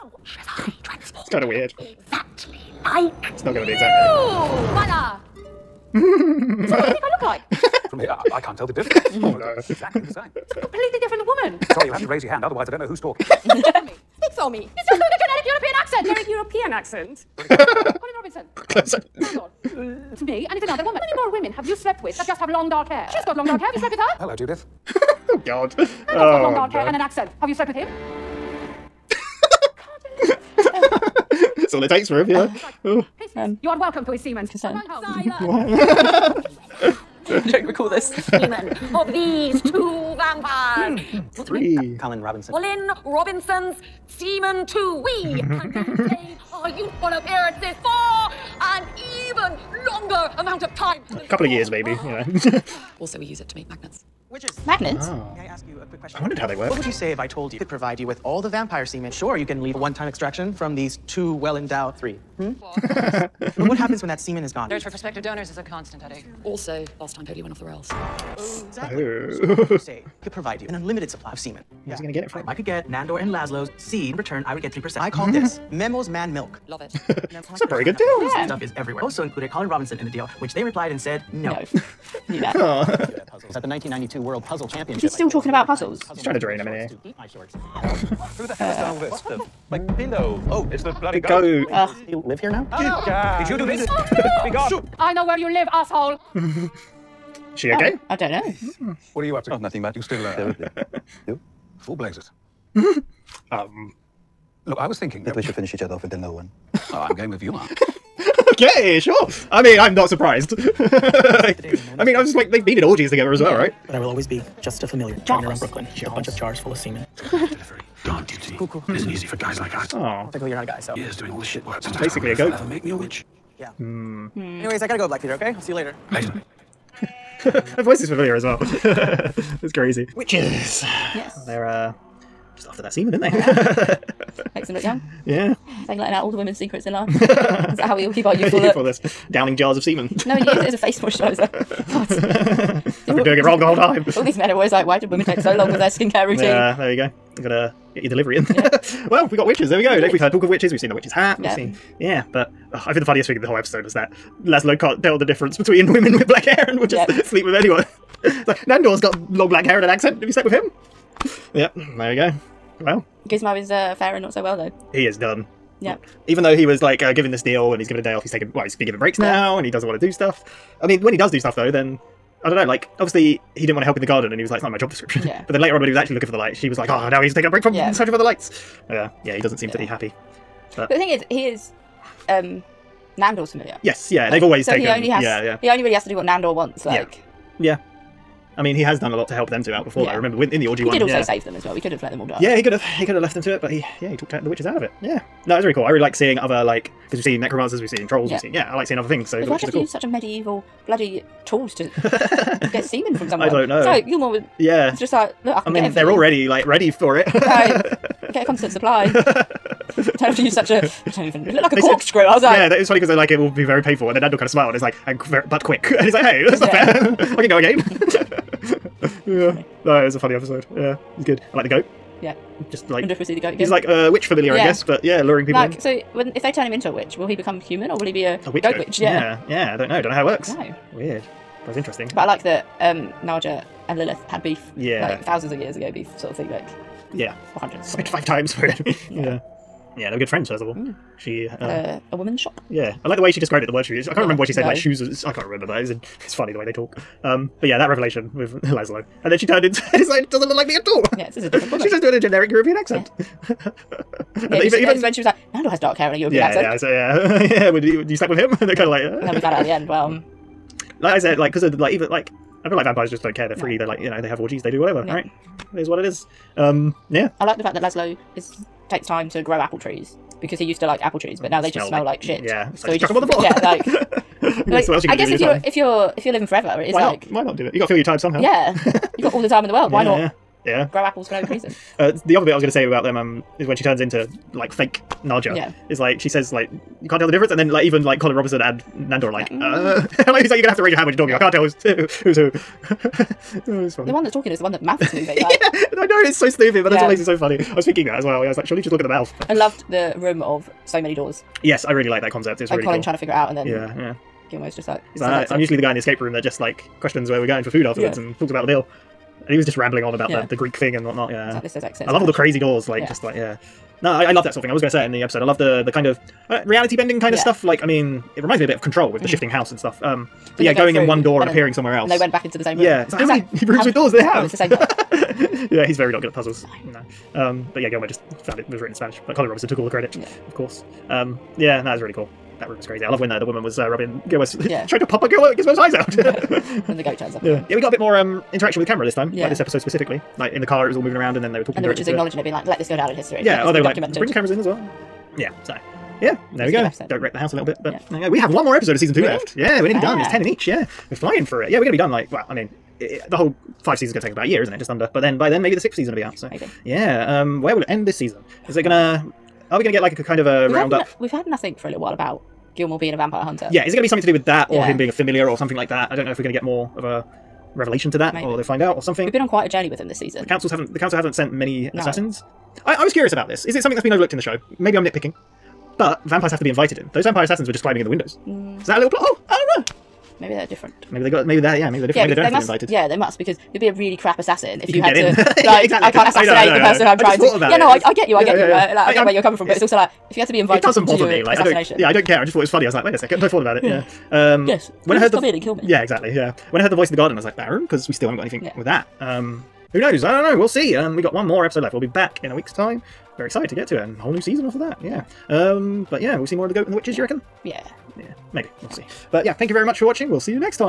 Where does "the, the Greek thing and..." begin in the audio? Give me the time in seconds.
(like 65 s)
310 s.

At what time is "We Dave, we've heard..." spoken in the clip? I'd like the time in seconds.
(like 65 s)
149 s.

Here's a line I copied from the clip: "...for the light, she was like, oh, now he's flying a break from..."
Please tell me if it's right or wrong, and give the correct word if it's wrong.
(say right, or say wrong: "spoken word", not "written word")
wrong: "taking", not "flying".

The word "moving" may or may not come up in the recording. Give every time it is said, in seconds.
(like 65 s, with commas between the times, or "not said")
295 s, 341 s.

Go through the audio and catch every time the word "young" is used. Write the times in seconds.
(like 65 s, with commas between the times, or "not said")
134 s.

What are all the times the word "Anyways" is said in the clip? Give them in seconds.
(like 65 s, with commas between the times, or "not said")
124 s.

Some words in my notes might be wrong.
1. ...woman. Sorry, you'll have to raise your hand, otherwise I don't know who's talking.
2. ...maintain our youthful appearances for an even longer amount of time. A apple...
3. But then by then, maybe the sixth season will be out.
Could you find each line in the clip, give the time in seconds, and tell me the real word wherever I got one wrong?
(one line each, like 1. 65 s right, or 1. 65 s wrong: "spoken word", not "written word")
1. 11 s right
2. 45 s wrong: "couple", not "apple"
3. 355 s right.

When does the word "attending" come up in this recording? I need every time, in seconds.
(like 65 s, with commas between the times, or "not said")
not said.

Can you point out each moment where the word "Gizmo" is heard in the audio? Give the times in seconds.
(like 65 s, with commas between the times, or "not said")
163 s, 335 s.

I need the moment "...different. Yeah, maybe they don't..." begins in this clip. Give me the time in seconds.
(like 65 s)
382 s.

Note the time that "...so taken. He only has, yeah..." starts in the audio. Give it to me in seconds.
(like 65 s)
184 s.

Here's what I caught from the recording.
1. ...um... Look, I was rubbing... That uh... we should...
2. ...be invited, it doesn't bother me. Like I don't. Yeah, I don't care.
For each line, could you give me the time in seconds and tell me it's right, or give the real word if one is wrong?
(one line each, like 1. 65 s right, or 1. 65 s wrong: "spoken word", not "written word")
1. 103 s wrong: "thinking", not "rubbing"
2. 390 s right.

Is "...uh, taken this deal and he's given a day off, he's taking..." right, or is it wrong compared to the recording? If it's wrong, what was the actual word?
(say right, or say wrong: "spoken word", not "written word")
wrong: "given", not "taken".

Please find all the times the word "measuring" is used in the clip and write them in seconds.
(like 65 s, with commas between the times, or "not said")
not said.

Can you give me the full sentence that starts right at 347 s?
Don't wreck the house a little bit, but yeah.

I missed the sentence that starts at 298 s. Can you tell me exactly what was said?
Yeah, I was like, surely just look at the mouth.